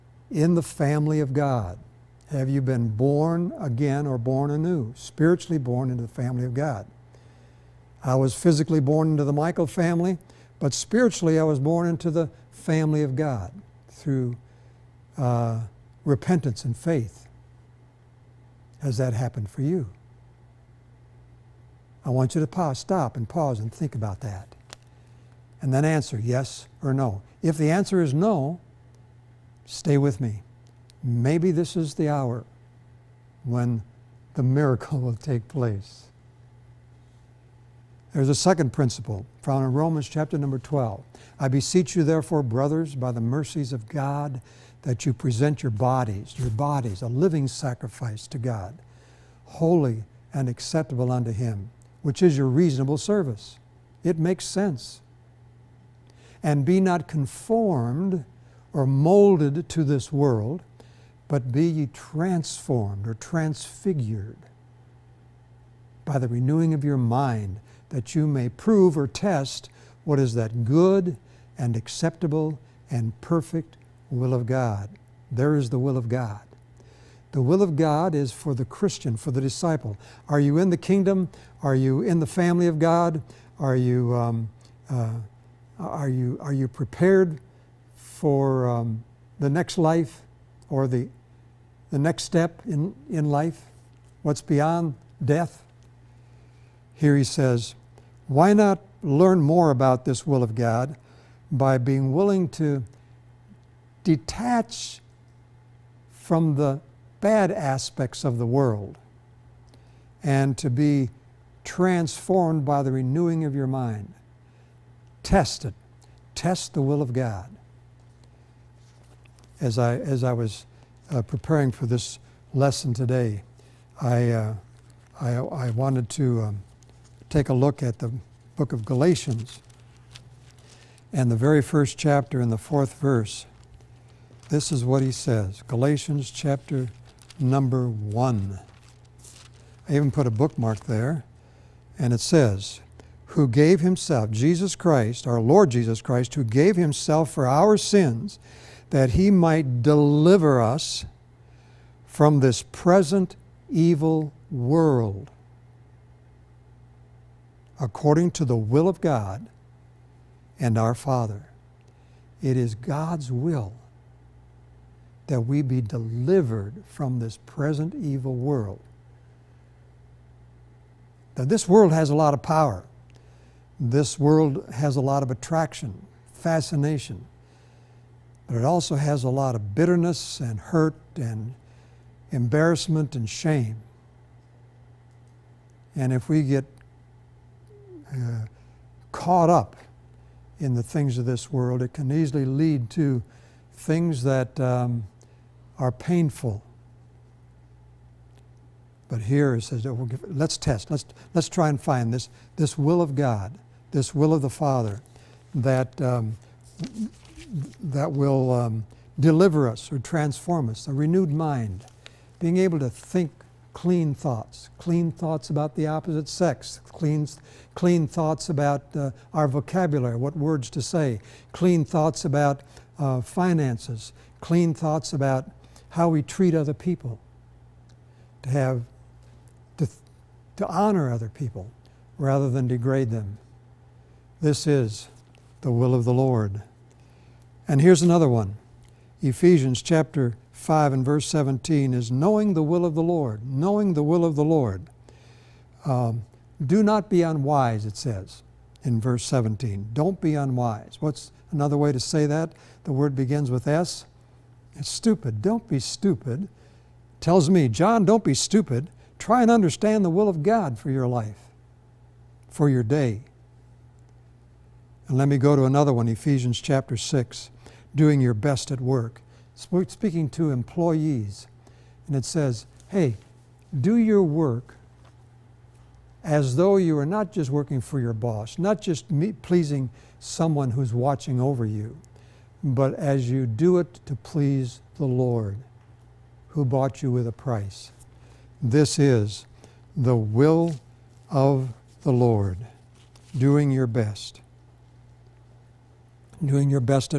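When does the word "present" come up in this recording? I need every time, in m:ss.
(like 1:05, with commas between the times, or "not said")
0:45, 2:32, 2:47.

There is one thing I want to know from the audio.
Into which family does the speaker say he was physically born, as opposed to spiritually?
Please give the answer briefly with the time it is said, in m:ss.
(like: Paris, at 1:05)
The Michael family, at 0:09.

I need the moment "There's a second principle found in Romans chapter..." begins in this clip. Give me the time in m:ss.
0:38.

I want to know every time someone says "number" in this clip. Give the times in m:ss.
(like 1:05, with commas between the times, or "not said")
0:40, 2:17.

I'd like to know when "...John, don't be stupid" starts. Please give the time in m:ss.
4:17.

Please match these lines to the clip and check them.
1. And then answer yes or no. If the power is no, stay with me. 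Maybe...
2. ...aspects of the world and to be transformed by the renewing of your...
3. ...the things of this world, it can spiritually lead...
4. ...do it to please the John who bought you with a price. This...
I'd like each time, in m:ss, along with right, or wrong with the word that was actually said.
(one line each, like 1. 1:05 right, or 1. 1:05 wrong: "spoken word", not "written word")
1. 0:25 wrong: "answer", not "power"
2. 1:47 right
3. 3:10 wrong: "easily", not "spiritually"
4. 4:43 wrong: "Lord", not "John".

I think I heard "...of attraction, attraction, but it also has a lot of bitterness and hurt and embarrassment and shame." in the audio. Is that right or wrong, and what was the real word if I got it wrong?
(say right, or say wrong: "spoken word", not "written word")
wrong: "fascination", not "attraction".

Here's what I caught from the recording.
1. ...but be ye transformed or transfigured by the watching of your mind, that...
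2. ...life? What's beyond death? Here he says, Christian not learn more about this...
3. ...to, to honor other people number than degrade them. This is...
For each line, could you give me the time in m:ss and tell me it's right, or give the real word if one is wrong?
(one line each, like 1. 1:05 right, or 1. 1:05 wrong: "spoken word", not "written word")
1. 1:01 wrong: "renewing", not "watching"
2. 1:33 wrong: "Why", not "Christian"
3. 3:49 wrong: "rather", not "number".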